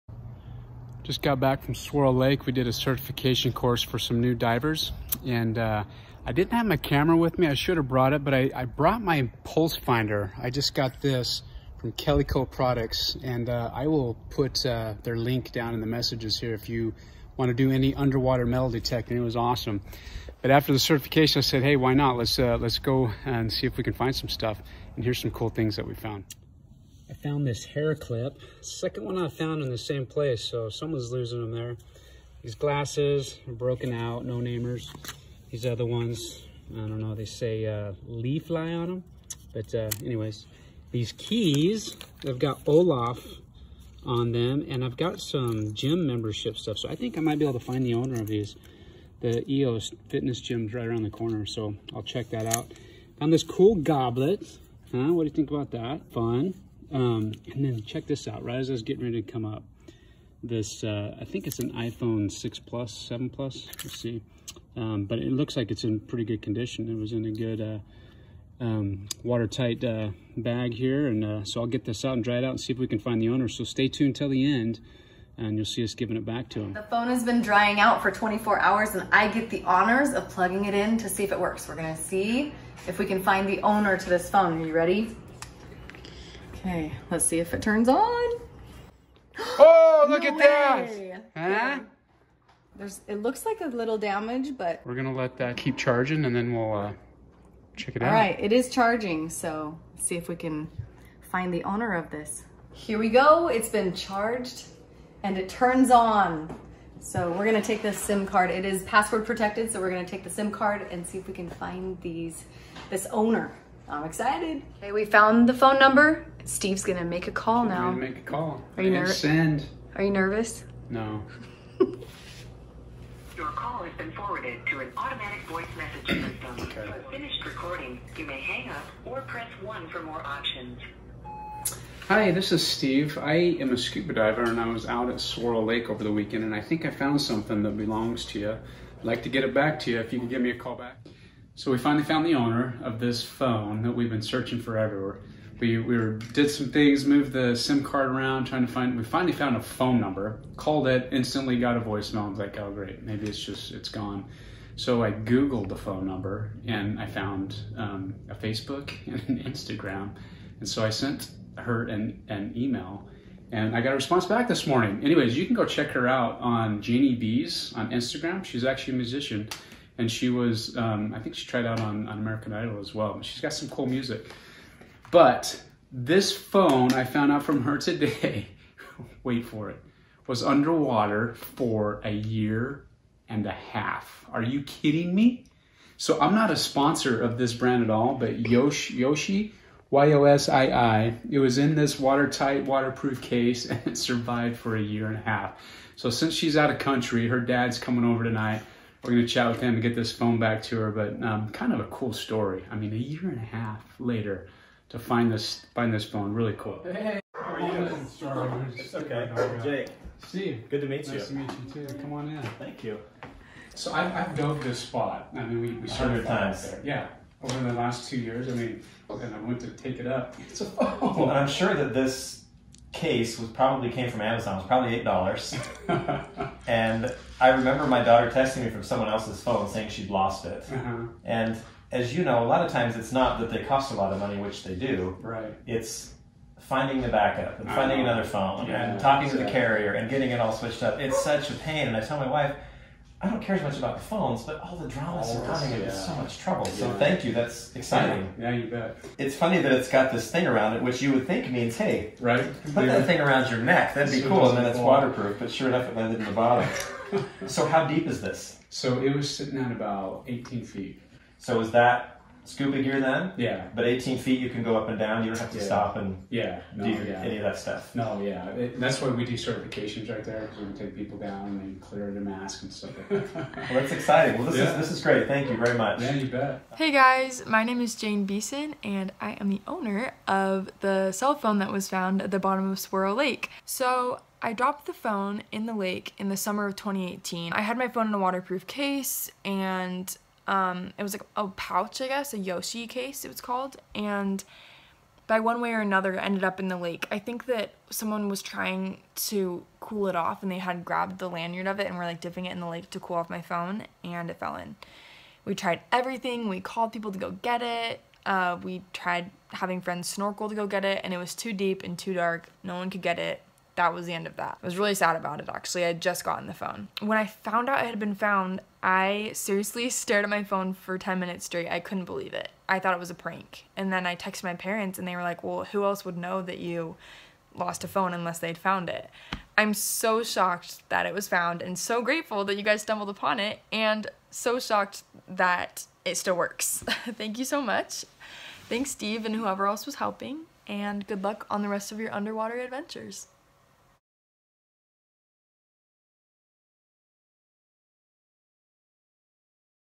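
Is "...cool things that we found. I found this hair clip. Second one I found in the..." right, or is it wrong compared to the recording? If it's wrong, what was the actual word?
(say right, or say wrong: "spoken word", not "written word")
right.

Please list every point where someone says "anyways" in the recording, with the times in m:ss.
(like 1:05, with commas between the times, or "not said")
0:40, 2:45.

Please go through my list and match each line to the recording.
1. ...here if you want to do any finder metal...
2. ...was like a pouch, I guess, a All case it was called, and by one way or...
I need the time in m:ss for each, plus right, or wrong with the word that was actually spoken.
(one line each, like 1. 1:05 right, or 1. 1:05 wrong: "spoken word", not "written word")
1. 0:16 wrong: "underwater", not "finder"
2. 4:51 wrong: "Yoshi", not "All".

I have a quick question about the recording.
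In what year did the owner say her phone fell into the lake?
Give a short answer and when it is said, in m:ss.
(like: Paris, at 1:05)
2018, at 4:46.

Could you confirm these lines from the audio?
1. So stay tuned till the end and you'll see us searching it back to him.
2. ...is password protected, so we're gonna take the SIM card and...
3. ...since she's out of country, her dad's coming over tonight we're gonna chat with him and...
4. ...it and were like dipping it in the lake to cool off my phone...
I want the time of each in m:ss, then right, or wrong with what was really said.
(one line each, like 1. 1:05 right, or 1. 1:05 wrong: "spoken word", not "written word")
1. 1:13 wrong: "giving", not "searching"
2. 1:48 right
3. 3:16 right
4. 5:01 right.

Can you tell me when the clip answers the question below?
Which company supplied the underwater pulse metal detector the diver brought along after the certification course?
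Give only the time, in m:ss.
0:11.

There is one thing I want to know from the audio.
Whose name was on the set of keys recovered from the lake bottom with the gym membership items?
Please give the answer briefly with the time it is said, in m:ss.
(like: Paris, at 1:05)
Olaf, at 0:42.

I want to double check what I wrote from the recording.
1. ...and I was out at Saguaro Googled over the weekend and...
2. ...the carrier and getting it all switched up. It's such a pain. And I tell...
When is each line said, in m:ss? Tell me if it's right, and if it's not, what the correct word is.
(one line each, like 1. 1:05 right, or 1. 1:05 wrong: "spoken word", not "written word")
1. 2:14 wrong: "Lake", not "Googled"
2. 3:59 right.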